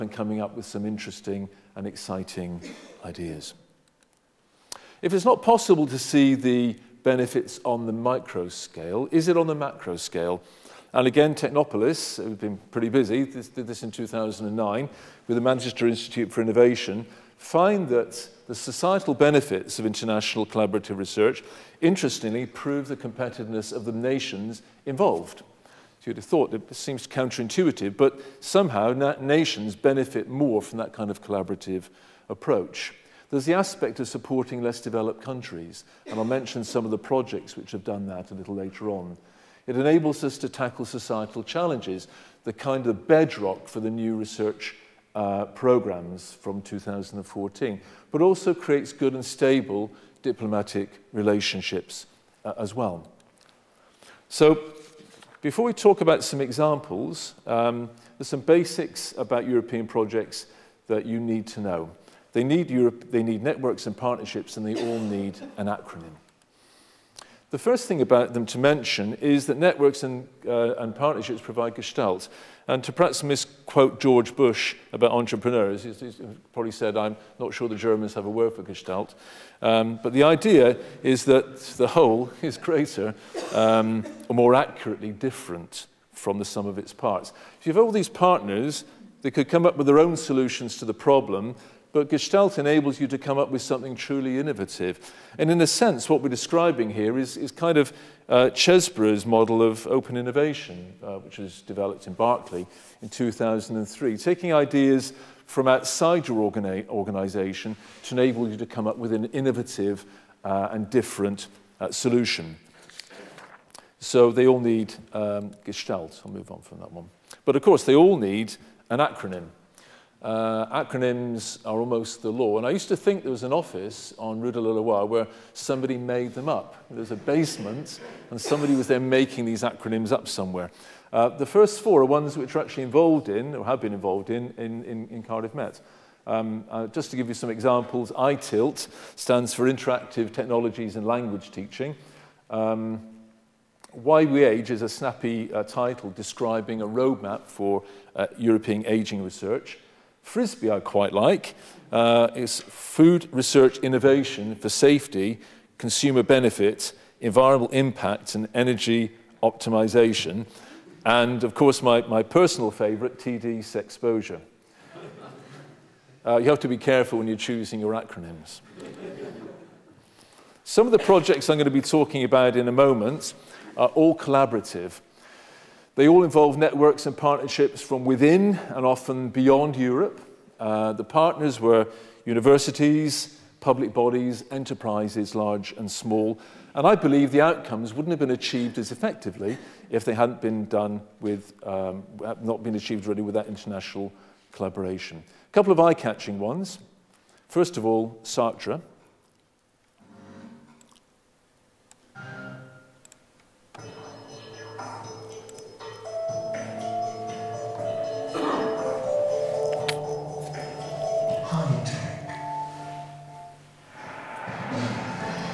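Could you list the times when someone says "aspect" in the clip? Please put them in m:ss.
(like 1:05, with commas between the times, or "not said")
0:33.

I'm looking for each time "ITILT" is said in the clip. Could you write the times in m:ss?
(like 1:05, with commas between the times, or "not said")
2:18.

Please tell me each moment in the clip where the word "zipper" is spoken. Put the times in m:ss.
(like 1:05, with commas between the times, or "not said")
not said.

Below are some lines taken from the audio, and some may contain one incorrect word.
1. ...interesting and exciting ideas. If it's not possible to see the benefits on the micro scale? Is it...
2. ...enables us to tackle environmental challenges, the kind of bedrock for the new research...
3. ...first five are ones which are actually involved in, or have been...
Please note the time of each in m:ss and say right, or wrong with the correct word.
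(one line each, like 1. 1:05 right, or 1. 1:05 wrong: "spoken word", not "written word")
1. 0:00 right
2. 0:39 wrong: "societal", not "environmental"
3. 2:11 wrong: "four", not "five".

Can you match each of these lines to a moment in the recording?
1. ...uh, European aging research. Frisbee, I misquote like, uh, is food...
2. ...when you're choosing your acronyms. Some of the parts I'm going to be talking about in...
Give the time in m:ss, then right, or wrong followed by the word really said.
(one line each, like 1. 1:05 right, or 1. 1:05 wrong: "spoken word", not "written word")
1. 2:28 wrong: "quite", not "misquote"
2. 2:47 wrong: "projects", not "parts".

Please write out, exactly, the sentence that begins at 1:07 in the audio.
The first thing about them to mention is that networks and, uh, and partnerships provide gestalt.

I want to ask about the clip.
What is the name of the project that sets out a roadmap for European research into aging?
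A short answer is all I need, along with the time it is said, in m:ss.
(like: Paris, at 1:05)
Why We Age, at 2:23.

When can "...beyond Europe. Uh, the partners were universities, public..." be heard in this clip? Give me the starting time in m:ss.
2:59.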